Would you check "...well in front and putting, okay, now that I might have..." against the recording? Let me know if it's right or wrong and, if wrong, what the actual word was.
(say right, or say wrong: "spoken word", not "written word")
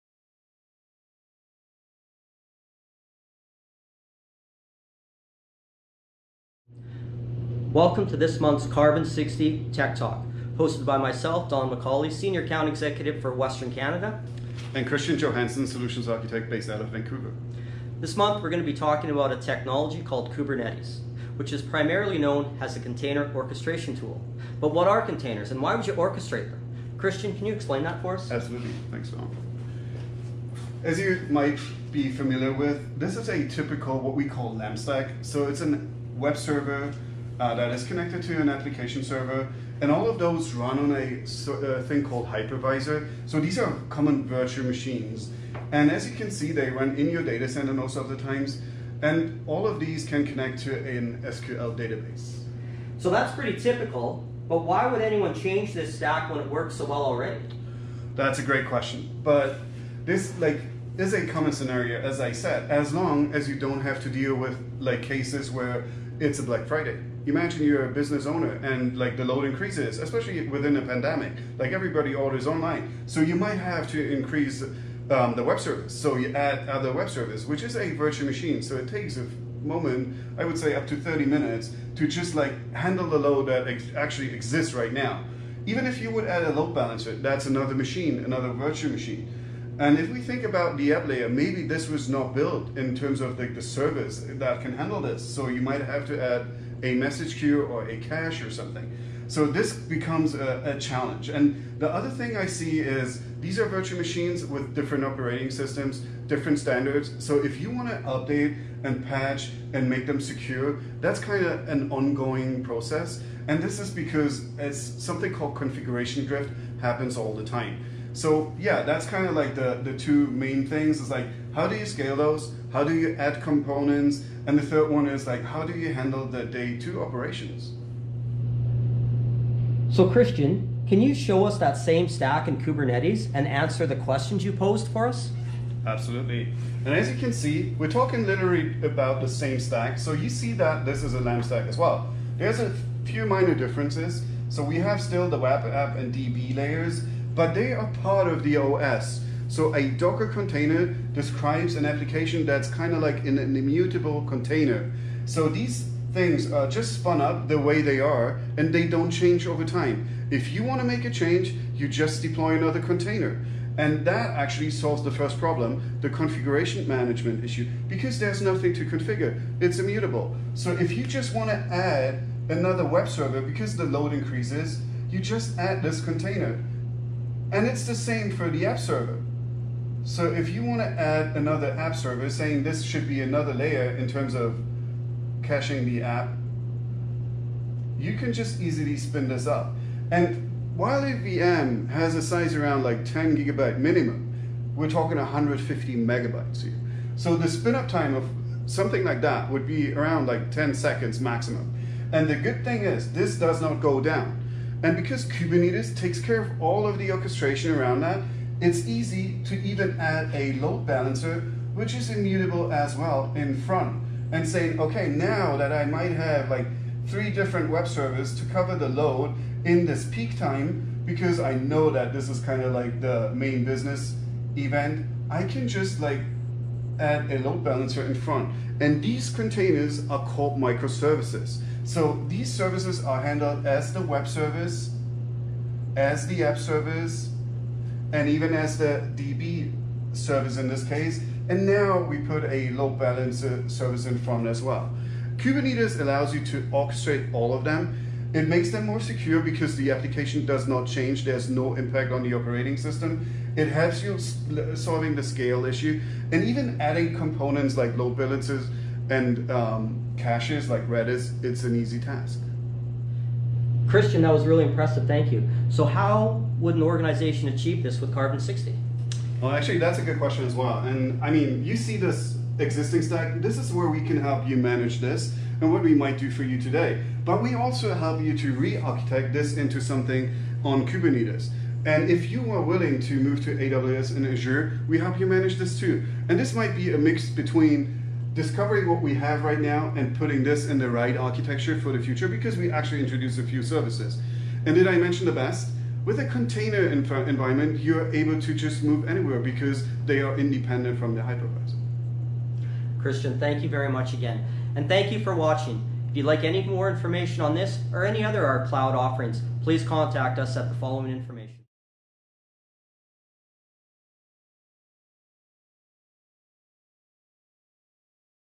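wrong: "saying", not "putting".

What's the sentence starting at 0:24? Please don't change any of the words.
But what are containers and why would you orchestrate them?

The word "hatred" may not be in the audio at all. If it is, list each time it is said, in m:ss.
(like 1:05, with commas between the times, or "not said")
not said.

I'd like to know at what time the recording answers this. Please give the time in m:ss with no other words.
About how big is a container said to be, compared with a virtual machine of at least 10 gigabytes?
3:15.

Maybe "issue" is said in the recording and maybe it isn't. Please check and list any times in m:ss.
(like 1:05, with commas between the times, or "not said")
2:47, 4:15.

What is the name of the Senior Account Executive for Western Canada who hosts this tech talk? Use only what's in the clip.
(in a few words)
Don Macaulay.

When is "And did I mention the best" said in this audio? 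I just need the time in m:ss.
4:54.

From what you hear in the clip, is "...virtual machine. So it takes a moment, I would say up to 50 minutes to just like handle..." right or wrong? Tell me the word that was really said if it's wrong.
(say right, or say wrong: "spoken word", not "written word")
wrong: "30", not "50".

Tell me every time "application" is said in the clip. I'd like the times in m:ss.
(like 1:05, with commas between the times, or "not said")
0:38, 2:31, 4:09.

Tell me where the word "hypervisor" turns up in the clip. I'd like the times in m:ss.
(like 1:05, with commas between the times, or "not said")
0:42, 5:01.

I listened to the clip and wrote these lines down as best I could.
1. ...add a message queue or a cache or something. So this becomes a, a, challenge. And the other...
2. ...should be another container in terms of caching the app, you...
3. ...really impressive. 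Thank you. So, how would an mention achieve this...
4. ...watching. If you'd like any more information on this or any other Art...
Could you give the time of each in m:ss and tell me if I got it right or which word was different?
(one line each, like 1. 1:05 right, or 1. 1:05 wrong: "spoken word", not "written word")
1. 1:36 right
2. 3:02 wrong: "layer", not "container"
3. 4:24 wrong: "organization", not "mention"
4. 5:05 right.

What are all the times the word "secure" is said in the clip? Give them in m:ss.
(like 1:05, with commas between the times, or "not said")
1:50, 4:08.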